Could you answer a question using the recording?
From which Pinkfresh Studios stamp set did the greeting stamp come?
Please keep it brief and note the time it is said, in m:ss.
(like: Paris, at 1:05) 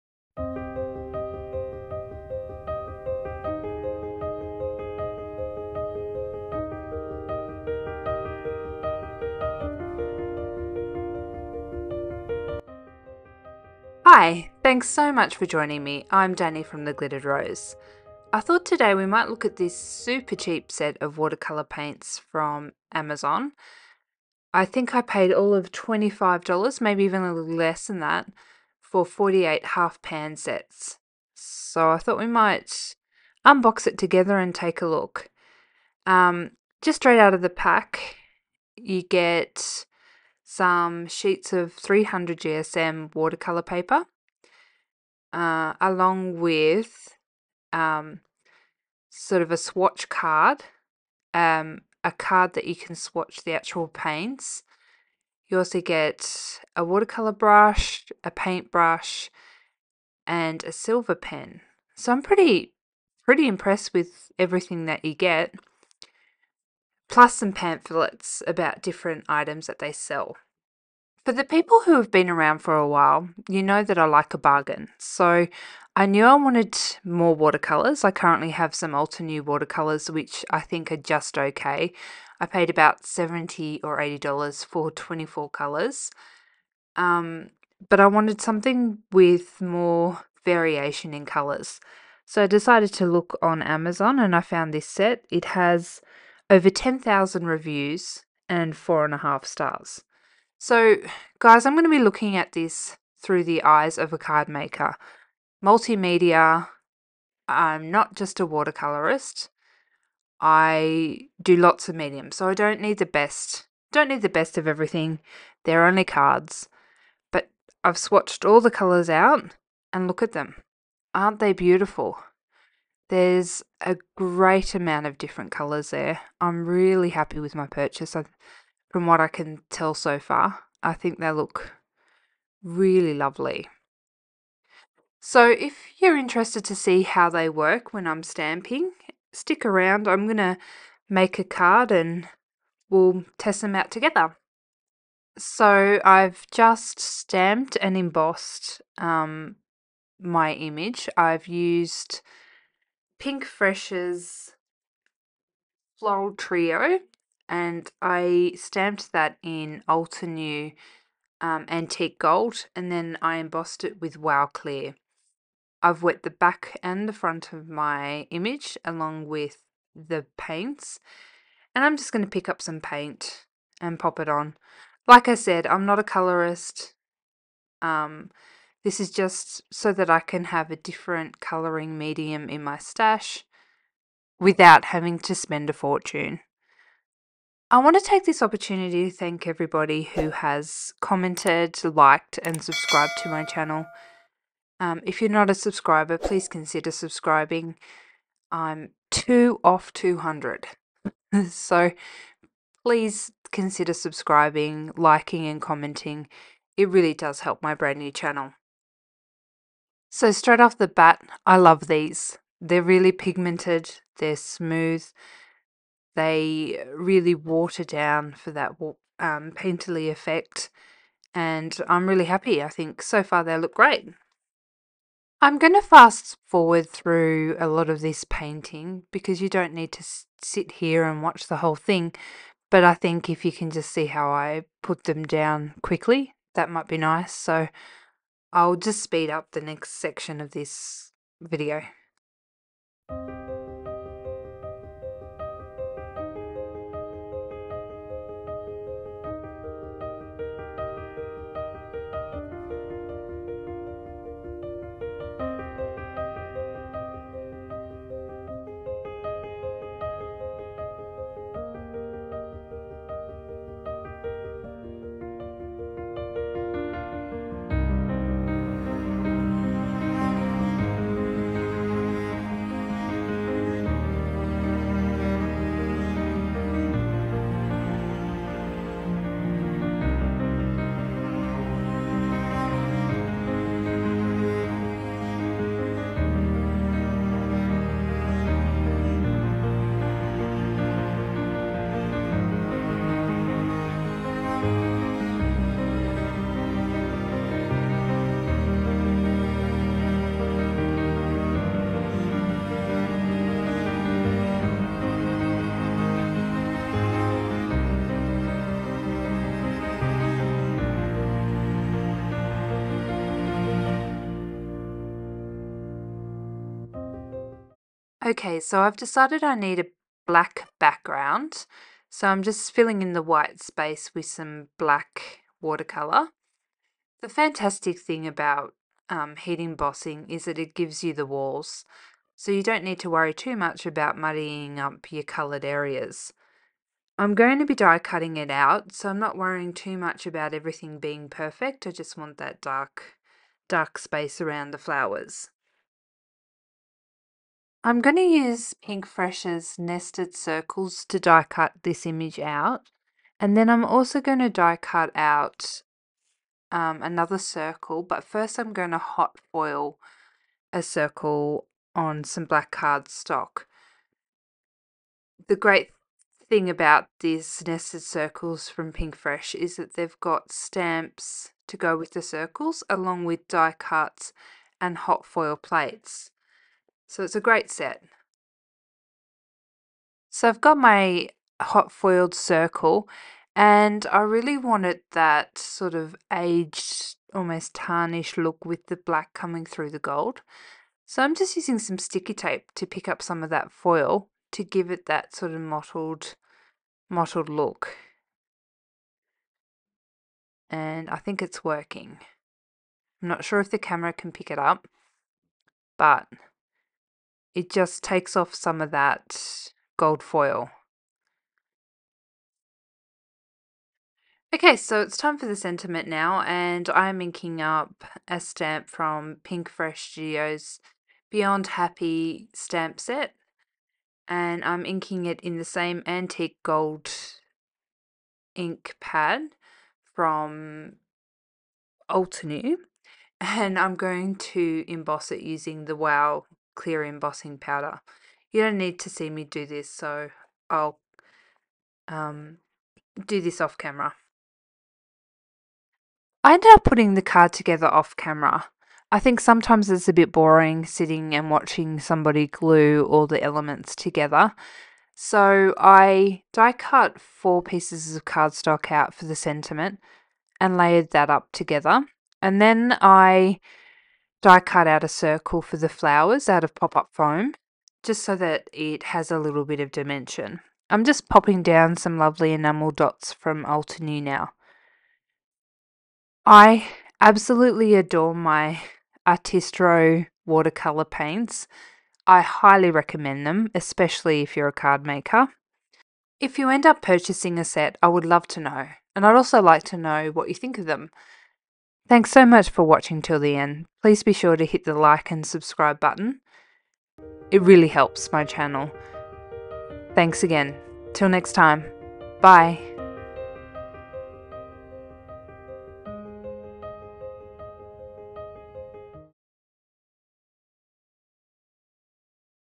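Beyond Happy, at 7:01.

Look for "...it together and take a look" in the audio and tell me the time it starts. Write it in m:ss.
0:33.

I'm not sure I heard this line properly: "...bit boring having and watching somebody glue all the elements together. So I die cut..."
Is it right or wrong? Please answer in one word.
wrong.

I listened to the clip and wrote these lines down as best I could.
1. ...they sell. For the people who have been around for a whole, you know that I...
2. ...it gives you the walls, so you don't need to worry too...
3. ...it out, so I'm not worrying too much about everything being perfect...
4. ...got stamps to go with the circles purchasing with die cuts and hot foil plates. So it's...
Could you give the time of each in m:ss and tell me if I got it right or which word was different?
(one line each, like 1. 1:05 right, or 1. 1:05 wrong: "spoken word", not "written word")
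1. 1:09 wrong: "while", not "whole"
2. 5:30 right
3. 5:38 right
4. 6:10 wrong: "along", not "purchasing".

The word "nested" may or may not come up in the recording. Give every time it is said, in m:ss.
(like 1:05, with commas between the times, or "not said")
5:49, 6:07.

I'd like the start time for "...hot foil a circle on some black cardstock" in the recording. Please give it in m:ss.
5:58.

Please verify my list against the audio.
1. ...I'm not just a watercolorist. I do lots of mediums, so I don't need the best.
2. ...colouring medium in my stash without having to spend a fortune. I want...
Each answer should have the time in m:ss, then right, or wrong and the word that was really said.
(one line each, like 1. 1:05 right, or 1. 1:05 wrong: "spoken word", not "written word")
1. 1:47 right
2. 3:01 right.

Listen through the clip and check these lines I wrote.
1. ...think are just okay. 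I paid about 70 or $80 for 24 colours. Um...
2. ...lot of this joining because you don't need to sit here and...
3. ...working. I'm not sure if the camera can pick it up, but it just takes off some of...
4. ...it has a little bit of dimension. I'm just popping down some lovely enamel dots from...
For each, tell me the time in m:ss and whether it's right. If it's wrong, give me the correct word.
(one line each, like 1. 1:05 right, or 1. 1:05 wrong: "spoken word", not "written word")
1. 1:20 right
2. 3:47 wrong: "painting", not "joining"
3. 6:41 right
4. 7:48 right.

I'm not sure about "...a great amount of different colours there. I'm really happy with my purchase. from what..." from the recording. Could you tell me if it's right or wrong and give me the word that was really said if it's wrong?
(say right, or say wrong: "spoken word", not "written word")
right.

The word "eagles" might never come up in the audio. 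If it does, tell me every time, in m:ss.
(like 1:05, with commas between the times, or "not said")
not said.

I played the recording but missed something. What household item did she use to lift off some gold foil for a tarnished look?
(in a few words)
sticky tape.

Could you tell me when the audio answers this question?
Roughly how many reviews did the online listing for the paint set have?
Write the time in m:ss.
1:36.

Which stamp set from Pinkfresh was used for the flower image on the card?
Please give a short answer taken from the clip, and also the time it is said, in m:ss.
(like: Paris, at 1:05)
Floral Trio, at 2:35.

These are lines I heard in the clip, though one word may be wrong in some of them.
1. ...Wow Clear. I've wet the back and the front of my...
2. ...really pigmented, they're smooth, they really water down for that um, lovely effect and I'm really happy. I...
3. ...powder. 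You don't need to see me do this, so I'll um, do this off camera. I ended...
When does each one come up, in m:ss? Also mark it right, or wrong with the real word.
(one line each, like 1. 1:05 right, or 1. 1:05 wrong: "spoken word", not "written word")
1. 2:44 right
2. 3:32 wrong: "painterly", not "lovely"
3. 7:17 right.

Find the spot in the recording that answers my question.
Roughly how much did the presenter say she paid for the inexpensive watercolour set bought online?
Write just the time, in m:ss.
0:25.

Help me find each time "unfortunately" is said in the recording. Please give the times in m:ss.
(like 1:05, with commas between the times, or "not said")
not said.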